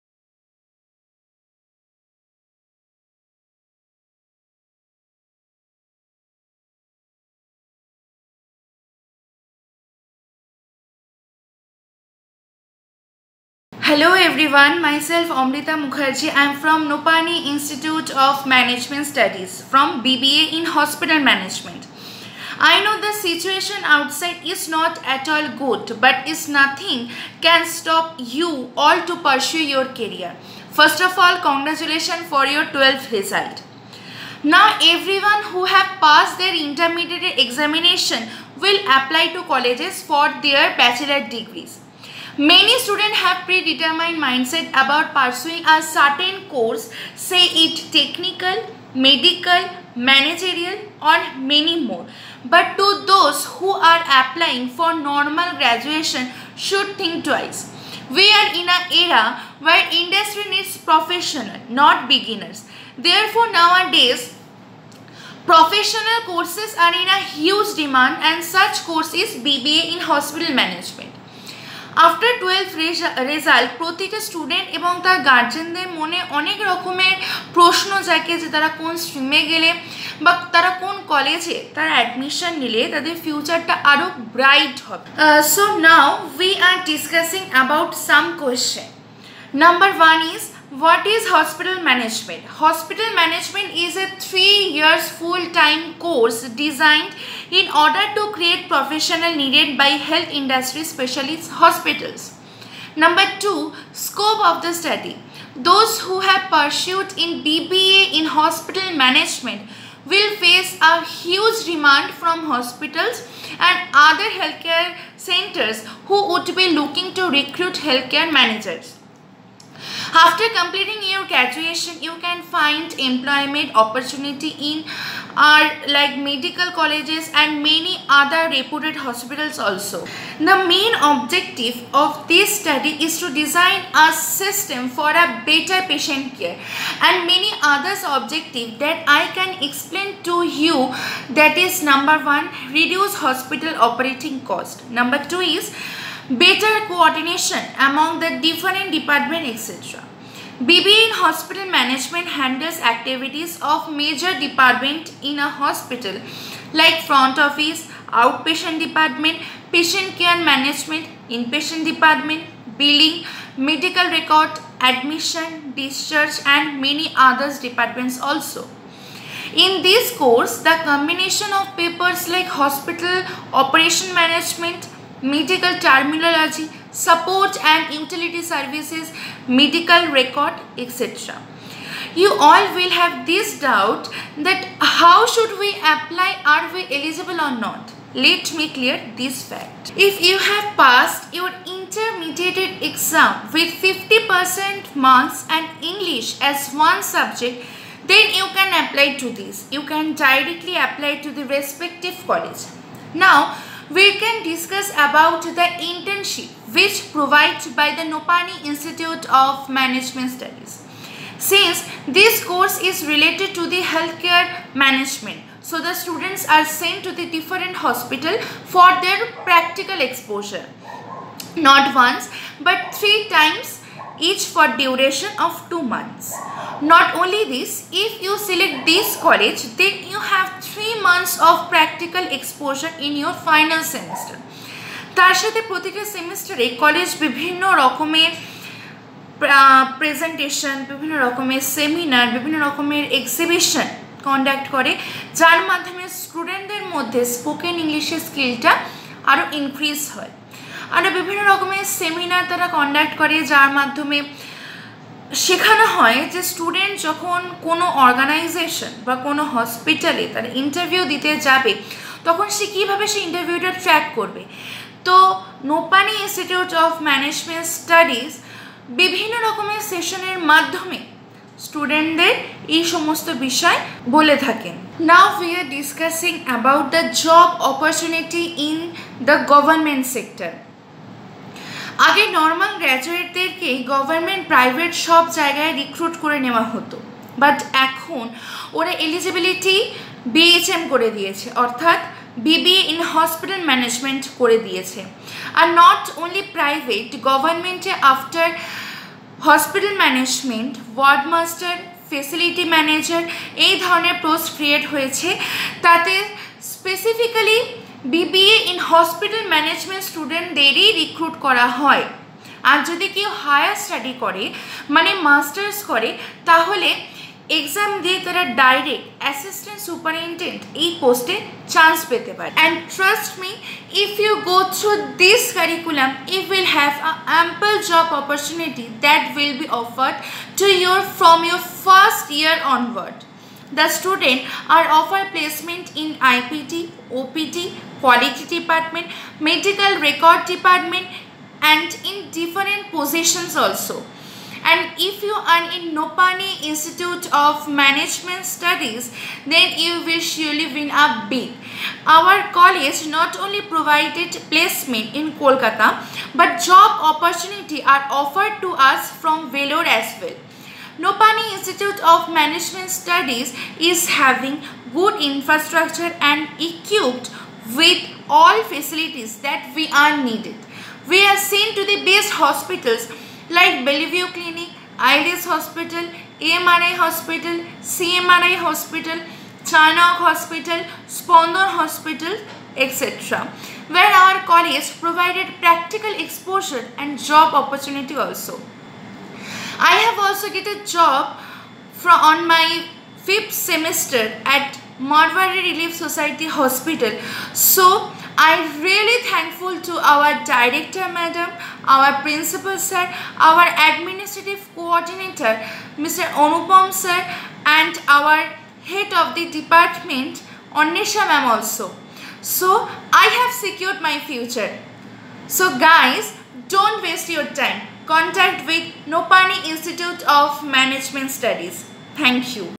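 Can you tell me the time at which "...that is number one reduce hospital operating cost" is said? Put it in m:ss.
2:21.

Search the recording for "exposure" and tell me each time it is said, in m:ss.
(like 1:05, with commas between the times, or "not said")
3:39, 3:52, 6:26.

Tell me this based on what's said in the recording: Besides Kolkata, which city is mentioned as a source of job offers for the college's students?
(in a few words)
Vellore.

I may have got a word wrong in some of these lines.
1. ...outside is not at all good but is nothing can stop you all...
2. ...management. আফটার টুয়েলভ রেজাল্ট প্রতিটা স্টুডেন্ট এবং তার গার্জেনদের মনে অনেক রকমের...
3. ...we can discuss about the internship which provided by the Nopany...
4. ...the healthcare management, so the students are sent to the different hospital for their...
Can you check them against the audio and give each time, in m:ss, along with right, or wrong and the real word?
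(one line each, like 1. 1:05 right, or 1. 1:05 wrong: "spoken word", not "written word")
1. 0:23 right
2. 1:10 right
3. 3:23 right
4. 3:33 right.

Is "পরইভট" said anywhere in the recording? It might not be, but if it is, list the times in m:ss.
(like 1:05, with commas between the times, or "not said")
4:44, 4:56.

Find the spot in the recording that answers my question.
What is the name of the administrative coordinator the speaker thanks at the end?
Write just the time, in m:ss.
6:46.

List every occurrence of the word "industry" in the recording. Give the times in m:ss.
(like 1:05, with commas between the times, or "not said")
0:59, 1:40.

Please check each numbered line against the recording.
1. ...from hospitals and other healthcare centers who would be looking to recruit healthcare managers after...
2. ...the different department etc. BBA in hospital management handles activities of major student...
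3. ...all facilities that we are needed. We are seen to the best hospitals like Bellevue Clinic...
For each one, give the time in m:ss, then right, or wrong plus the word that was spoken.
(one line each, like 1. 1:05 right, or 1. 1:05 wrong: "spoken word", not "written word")
1. 1:52 right
2. 2:28 wrong: "department", not "student"
3. 6:08 right.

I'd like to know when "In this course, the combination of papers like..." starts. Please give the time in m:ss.
2:49.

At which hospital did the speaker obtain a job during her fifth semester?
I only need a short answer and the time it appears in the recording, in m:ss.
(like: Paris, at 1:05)
Marwari Relief Society Hospital, at 6:34.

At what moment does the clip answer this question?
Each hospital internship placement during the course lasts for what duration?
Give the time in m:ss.
3:45.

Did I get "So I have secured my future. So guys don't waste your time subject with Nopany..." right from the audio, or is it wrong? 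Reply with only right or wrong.
wrong.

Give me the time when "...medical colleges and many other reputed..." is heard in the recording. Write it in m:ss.
2:06.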